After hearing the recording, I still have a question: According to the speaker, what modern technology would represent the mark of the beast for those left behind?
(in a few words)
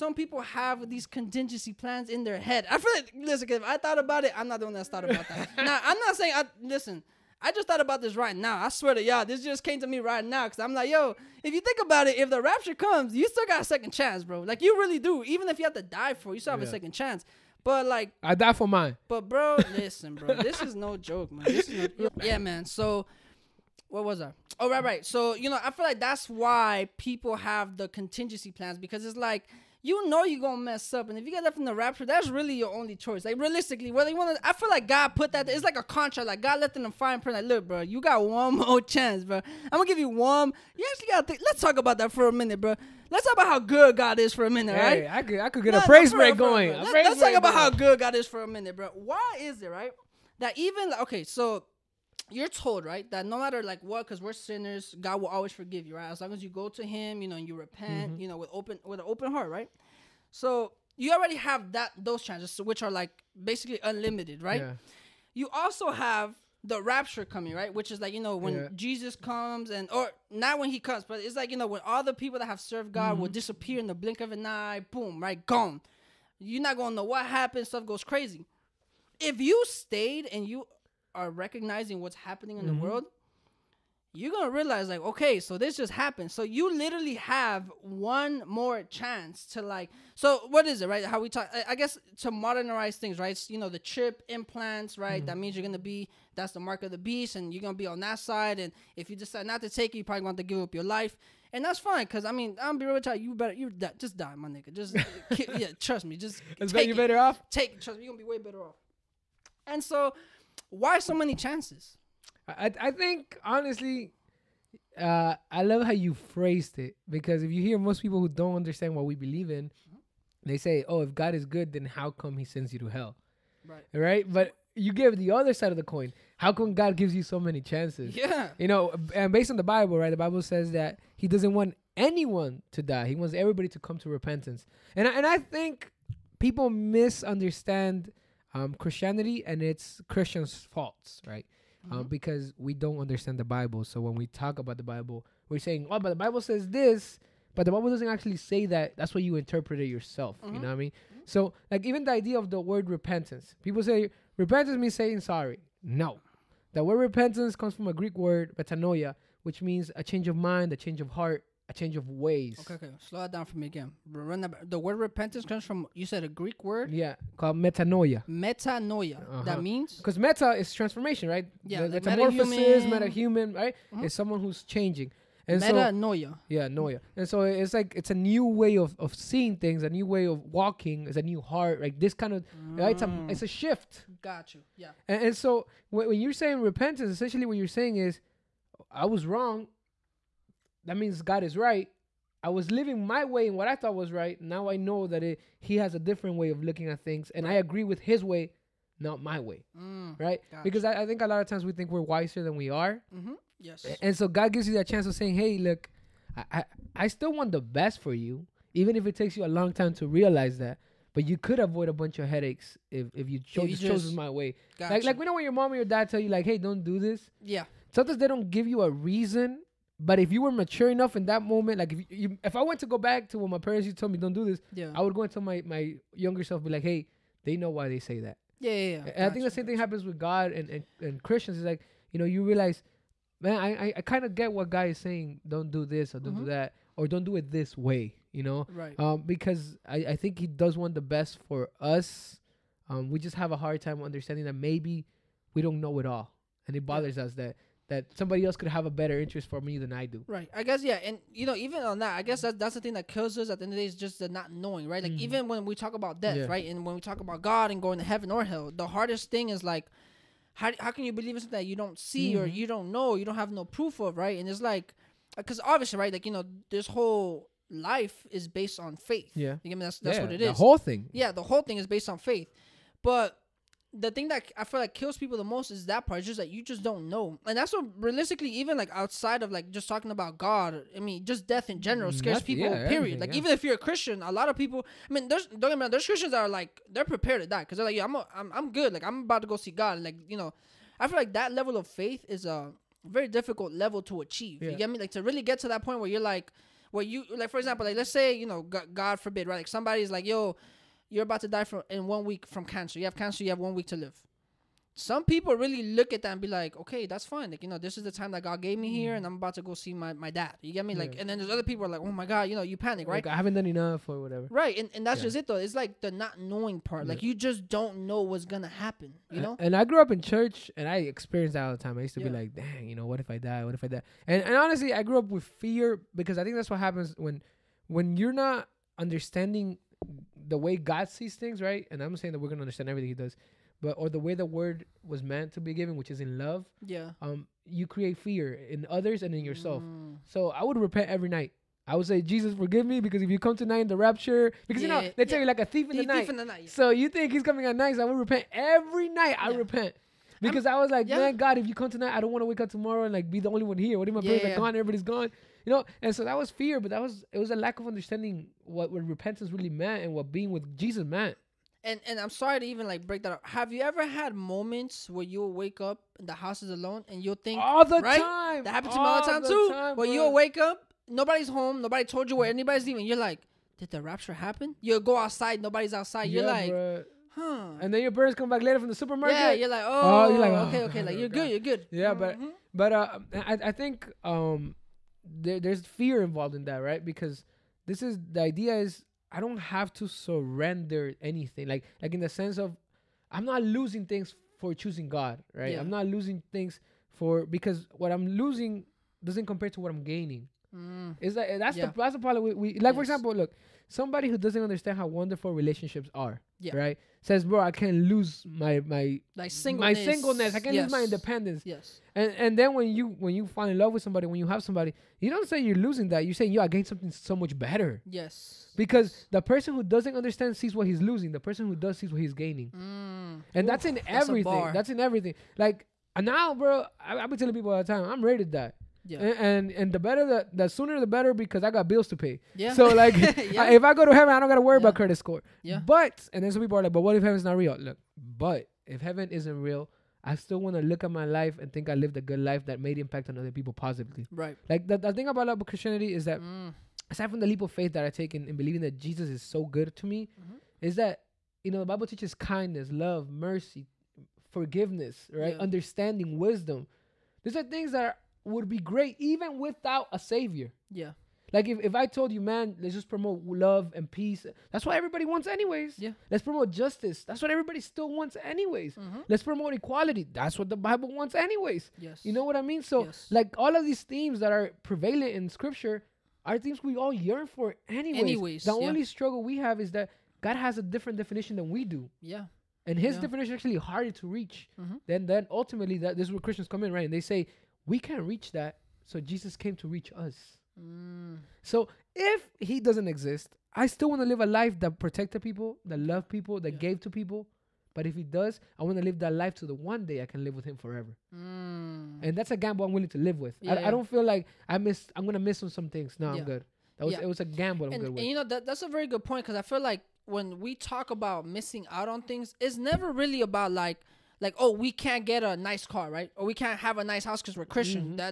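chip implants.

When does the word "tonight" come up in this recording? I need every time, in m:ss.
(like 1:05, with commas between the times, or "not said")
5:43, 5:51.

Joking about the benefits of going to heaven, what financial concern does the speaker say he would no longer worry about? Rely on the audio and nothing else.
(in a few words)
credit score.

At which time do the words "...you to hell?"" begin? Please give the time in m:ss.
2:02.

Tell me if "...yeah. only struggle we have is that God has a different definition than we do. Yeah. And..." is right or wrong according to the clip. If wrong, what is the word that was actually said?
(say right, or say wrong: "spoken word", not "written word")
right.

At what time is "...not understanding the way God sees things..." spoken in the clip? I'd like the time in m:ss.
5:28.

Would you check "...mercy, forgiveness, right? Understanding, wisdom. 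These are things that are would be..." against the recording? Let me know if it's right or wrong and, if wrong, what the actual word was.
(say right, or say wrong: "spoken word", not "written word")
right.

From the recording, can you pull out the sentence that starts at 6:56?
You say, yo, I gained something so much better.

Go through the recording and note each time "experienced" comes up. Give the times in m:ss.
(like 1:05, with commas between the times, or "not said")
5:20.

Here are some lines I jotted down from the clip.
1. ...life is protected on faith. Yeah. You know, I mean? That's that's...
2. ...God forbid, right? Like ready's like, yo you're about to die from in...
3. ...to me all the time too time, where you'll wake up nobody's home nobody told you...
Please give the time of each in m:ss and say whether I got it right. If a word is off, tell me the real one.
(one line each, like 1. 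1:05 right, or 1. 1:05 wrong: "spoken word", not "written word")
1. 4:27 wrong: "based", not "protected"
2. 4:58 wrong: "somebody", not "ready"
3. 6:08 right.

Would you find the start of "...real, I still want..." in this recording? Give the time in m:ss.
7:19.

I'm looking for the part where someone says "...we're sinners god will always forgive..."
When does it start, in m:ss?
0:54.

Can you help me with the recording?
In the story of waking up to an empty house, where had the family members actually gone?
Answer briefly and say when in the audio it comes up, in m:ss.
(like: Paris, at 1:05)
the supermarket, at 6:18.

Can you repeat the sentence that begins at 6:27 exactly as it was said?
Because this is the idea is I don't have to surrender anything.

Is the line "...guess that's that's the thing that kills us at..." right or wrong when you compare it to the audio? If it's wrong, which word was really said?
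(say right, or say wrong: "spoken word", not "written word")
right.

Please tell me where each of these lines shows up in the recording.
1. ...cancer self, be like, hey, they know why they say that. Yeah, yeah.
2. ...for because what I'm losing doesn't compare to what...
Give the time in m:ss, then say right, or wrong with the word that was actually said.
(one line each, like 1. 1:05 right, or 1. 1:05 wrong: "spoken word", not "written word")
1. 3:46 wrong: "younger", not "cancer"
2. 6:37 right.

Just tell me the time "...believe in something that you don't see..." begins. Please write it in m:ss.
4:21.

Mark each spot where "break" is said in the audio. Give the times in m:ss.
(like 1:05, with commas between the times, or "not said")
0:46, 6:03.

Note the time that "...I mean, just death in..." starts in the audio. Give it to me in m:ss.
4:40.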